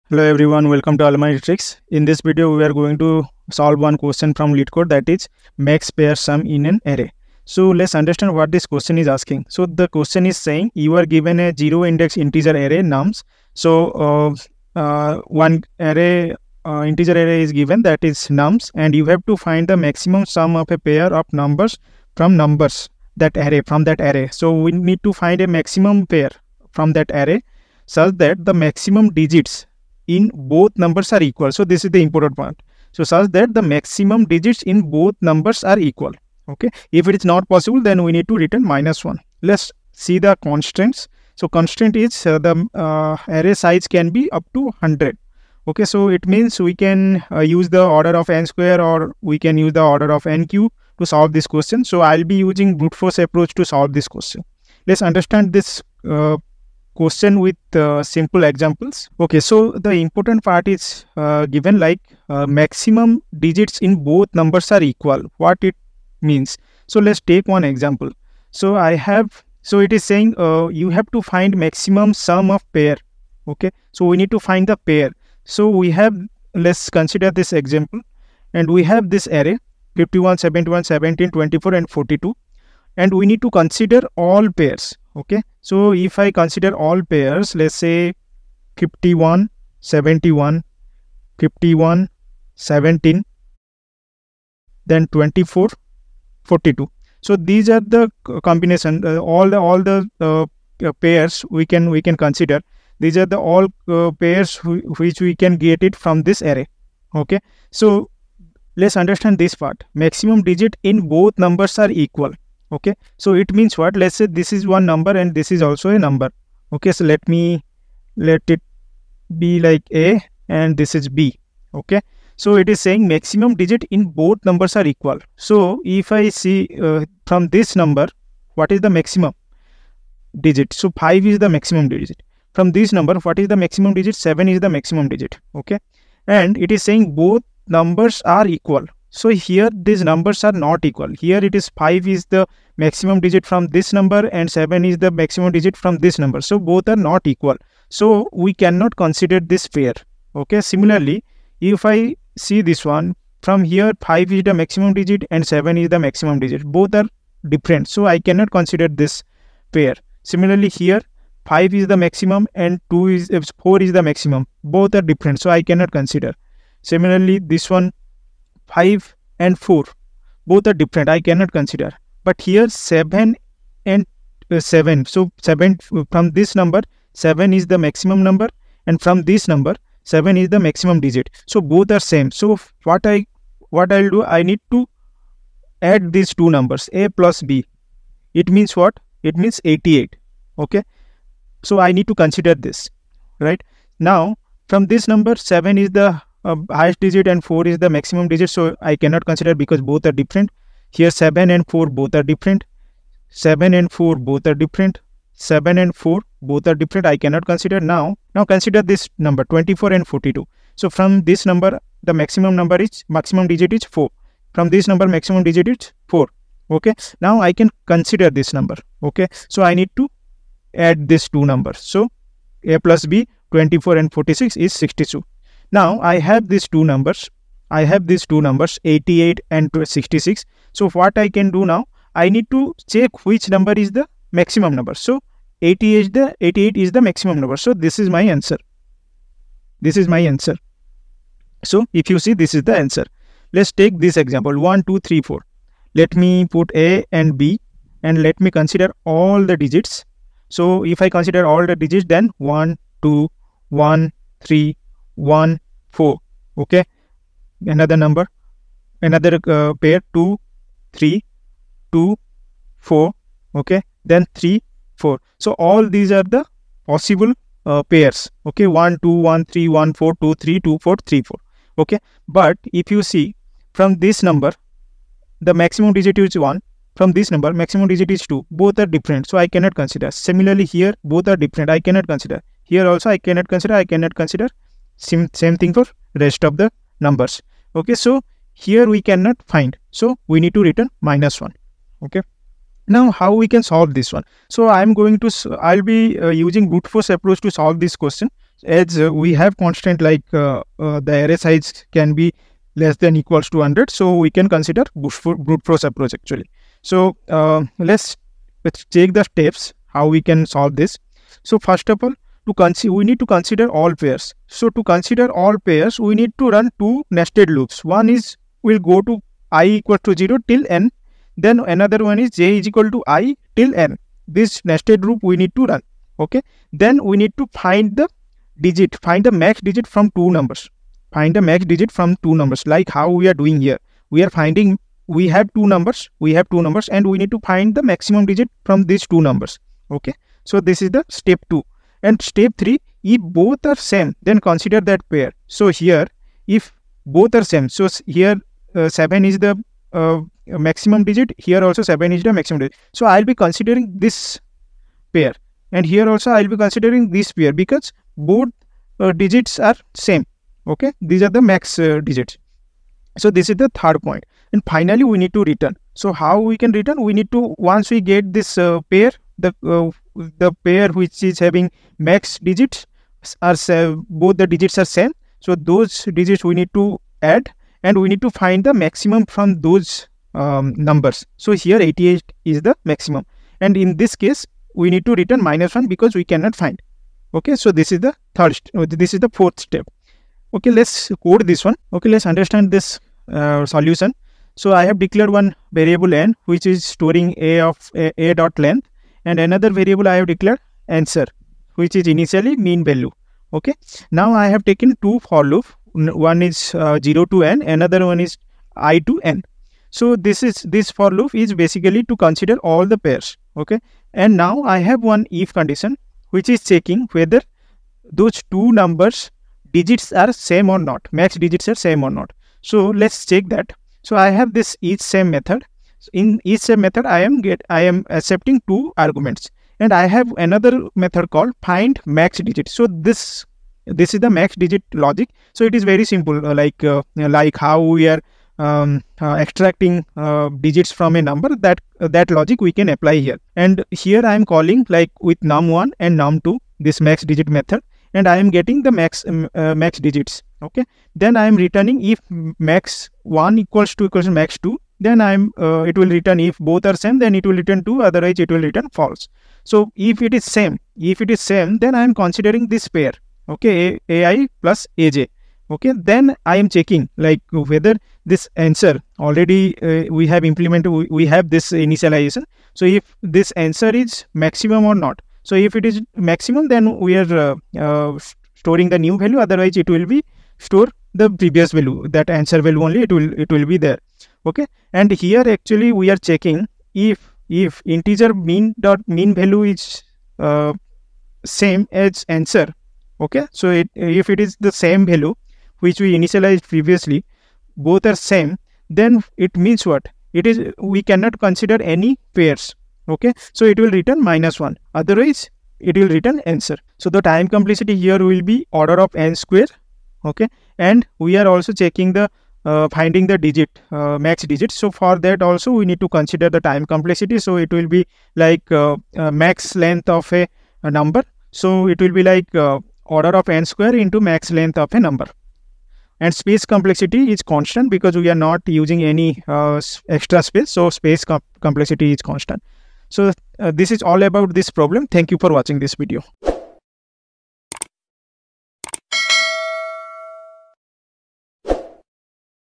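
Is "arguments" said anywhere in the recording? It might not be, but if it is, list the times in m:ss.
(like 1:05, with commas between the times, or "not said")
7:08.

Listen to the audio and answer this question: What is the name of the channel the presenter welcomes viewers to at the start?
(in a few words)
Almighty Tricks.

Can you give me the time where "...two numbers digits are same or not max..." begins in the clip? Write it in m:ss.
6:58.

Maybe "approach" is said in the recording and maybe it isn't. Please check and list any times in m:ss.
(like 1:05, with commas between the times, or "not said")
0:53, 4:57, 5:05.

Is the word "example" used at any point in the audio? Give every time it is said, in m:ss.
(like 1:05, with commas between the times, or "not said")
0:58, 1:07, 1:17, 4:04.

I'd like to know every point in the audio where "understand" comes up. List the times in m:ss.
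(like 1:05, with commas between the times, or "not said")
0:07, 0:55, 1:48, 6:32.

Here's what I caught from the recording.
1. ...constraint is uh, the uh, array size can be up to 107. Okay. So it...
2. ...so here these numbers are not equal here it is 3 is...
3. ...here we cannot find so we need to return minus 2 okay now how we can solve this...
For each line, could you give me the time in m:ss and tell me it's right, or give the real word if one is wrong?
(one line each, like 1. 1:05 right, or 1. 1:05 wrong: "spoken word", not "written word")
1. 0:41 wrong: "100", not "107"
2. 2:19 wrong: "5", not "3"
3. 4:48 wrong: "1", not "2".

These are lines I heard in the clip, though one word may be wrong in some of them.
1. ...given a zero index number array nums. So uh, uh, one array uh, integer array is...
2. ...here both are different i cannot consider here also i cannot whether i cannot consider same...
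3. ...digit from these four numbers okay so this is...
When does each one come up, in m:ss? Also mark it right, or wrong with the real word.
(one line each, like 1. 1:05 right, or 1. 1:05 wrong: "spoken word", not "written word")
1. 0:11 wrong: "integer", not "number"
2. 4:40 wrong: "consider", not "whether"
3. 5:38 wrong: "two", not "four".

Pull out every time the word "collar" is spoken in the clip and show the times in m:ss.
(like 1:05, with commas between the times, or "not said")
not said.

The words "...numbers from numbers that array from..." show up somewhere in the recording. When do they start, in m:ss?
0:21.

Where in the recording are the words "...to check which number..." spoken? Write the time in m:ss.
3:52.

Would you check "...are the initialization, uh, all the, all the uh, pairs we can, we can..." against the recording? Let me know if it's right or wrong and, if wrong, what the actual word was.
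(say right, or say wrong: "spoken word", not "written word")
wrong: "combination", not "initialization".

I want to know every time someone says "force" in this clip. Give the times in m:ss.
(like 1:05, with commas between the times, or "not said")
0:52, 4:56, 5:05.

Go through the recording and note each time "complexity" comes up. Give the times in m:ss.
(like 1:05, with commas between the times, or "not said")
8:27, 8:36, 8:46, 8:51.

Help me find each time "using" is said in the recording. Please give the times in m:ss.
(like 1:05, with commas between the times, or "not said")
0:52, 4:56, 8:48.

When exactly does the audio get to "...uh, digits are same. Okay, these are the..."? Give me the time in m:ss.
5:58.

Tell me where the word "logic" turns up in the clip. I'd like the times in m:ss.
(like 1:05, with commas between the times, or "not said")
7:15, 7:22.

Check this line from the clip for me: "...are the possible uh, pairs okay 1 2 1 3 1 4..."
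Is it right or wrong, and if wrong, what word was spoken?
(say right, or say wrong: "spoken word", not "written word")
right.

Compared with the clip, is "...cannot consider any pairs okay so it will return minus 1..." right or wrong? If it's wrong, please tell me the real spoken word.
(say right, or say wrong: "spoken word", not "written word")
right.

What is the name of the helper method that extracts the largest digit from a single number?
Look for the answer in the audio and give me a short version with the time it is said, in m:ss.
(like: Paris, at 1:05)
find max digit, at 7:11.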